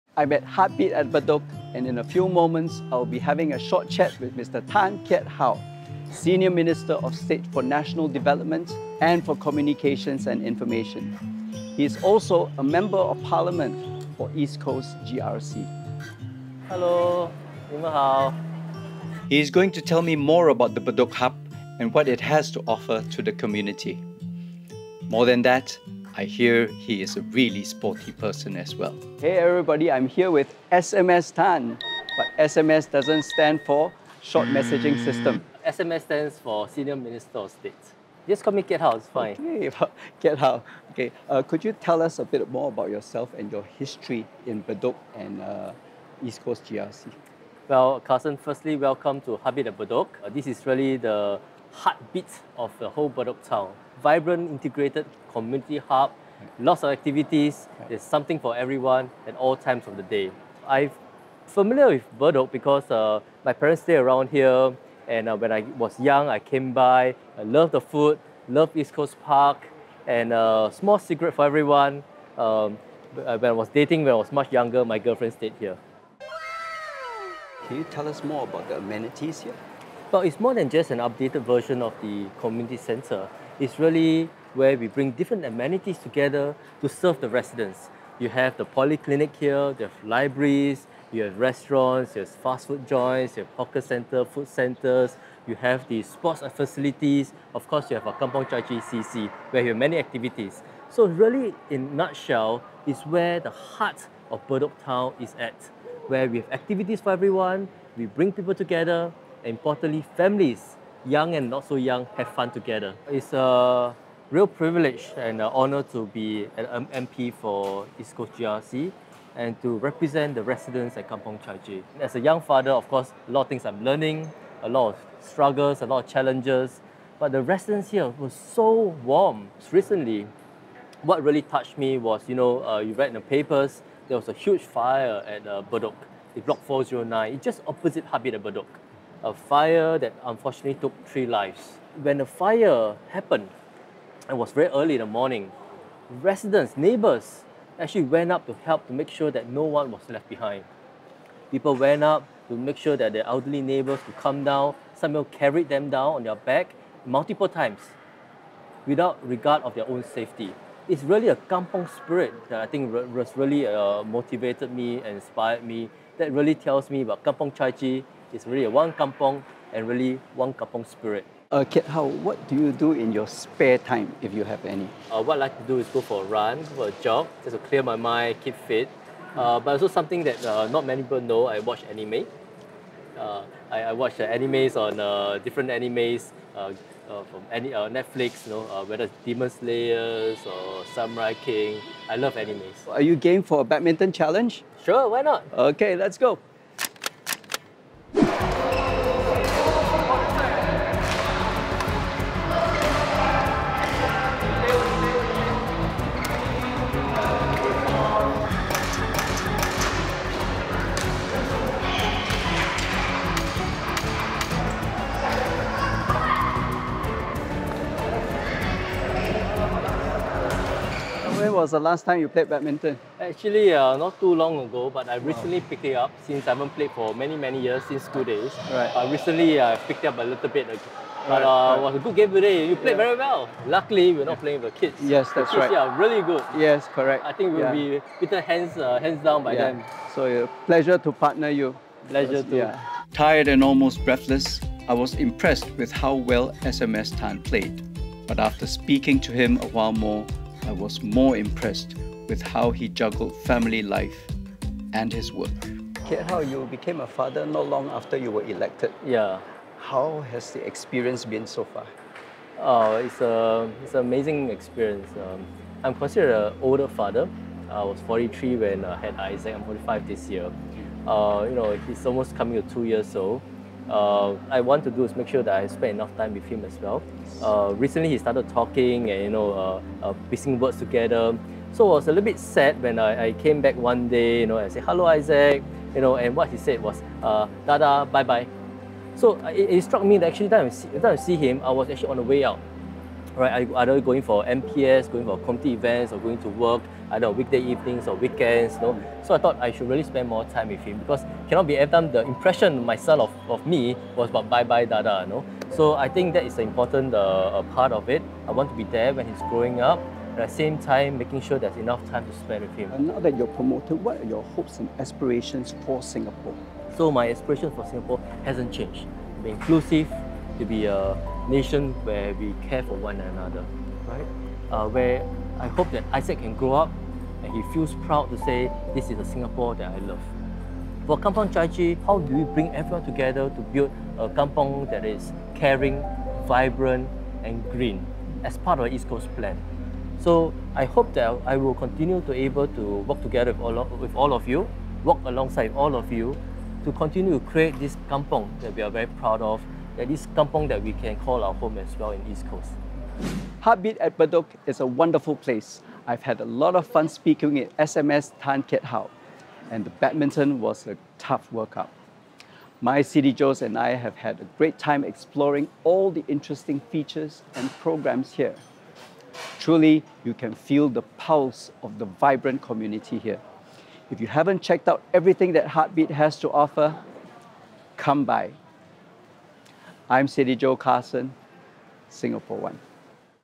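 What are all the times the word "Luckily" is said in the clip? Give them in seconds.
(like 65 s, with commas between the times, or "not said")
233 s.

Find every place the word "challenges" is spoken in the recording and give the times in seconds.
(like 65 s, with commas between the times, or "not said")
126 s, 194 s.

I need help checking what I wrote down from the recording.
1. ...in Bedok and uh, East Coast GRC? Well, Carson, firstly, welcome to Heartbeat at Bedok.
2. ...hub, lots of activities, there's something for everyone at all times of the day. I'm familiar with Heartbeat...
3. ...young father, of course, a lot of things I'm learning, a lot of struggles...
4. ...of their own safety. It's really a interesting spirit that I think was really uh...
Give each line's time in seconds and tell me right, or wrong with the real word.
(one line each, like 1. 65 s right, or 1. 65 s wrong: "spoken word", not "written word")
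1. 44 s right
2. 55 s wrong: "Bedok", not "Heartbeat"
3. 122 s right
4. 159 s wrong: "kampong", not "interesting".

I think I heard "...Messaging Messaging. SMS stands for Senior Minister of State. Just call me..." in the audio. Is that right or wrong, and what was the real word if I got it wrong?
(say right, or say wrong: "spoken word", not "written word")
wrong: "System", not "Messaging".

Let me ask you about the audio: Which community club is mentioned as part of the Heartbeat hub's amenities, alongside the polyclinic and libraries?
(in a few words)
Kampong Chai Chee CC.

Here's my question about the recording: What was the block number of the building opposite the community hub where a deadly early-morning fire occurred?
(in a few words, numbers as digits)
409.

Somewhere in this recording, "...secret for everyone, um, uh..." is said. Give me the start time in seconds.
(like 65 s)
70 s.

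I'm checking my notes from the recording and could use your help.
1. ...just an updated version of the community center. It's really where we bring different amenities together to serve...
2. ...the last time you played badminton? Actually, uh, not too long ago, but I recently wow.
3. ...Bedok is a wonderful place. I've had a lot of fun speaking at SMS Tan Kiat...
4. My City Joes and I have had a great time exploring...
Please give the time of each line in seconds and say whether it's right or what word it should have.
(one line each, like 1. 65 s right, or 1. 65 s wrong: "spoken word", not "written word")
1. 80 s right
2. 221 s right
3. 354 s right
4. 362 s right.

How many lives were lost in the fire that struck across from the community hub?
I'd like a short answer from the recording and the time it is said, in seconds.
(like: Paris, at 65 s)
3, at 141 s.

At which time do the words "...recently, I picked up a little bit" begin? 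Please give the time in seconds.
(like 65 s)
229 s.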